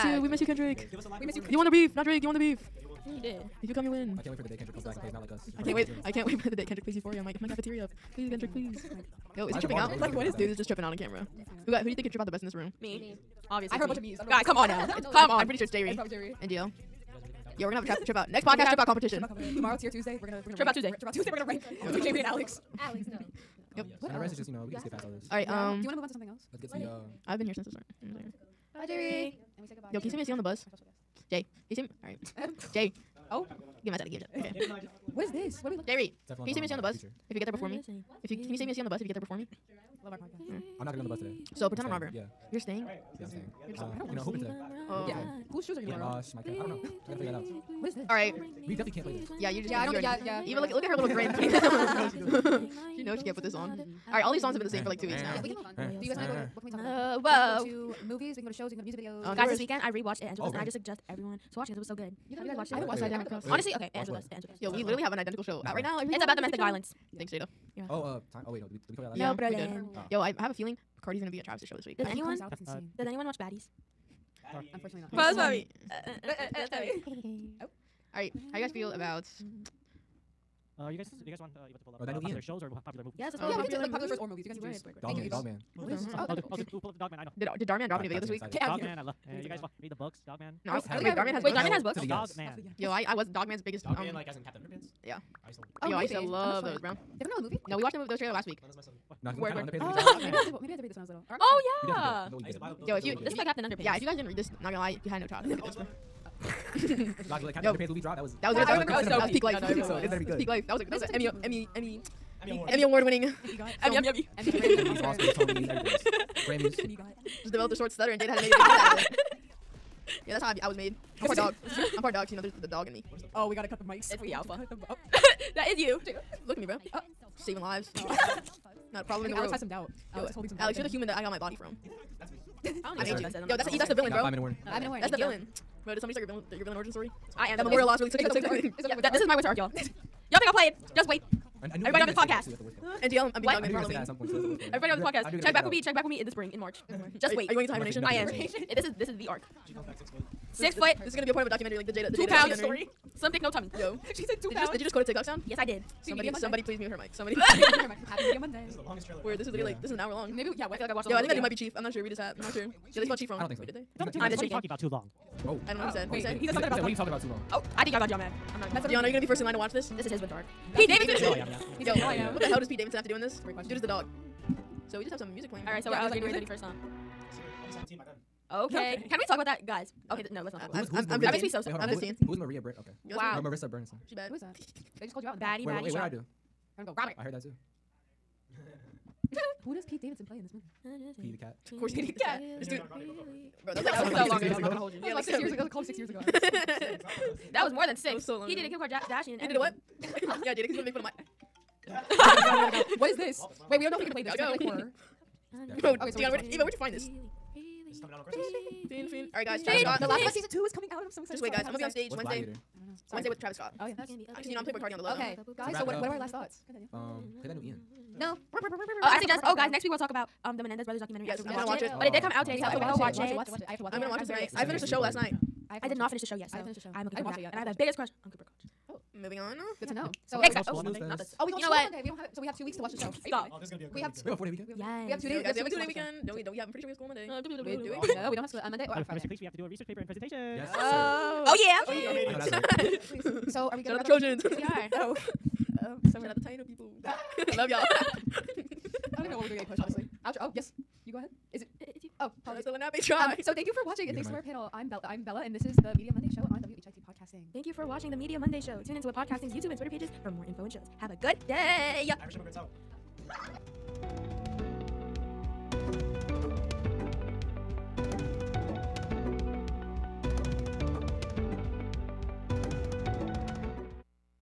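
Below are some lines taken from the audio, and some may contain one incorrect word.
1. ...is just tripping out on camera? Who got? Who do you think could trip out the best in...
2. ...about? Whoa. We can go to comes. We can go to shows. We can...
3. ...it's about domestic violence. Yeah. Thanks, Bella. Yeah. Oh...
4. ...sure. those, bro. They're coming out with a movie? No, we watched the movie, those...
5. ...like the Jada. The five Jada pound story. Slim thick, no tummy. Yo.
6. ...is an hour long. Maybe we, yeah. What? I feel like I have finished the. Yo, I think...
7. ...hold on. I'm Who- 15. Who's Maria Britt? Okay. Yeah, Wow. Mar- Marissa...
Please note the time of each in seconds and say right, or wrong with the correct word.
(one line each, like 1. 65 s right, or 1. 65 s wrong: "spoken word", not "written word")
1. 10 s right
2. 56 s wrong: "movies", not "comes"
3. 66 s wrong: "Jada", not "Bella"
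4. 96 s right
5. 151 s wrong: "two", not "five"
6. 159 s wrong: "watched", not "finished"
7. 181 s right.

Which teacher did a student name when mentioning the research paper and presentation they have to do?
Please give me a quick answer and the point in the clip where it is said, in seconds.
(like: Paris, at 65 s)
Mr. Cleese, at 239 s.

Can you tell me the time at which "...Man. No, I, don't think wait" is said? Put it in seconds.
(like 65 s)
90 s.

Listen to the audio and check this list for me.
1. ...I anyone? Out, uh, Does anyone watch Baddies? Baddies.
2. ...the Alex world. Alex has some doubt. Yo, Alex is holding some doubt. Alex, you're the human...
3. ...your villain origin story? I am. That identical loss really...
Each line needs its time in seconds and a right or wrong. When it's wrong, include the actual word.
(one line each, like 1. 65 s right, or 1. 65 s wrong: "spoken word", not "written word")
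1. 72 s right
2. 129 s right
3. 136 s wrong: "memorial", not "identical".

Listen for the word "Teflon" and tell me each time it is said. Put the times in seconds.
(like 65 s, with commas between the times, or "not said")
36 s.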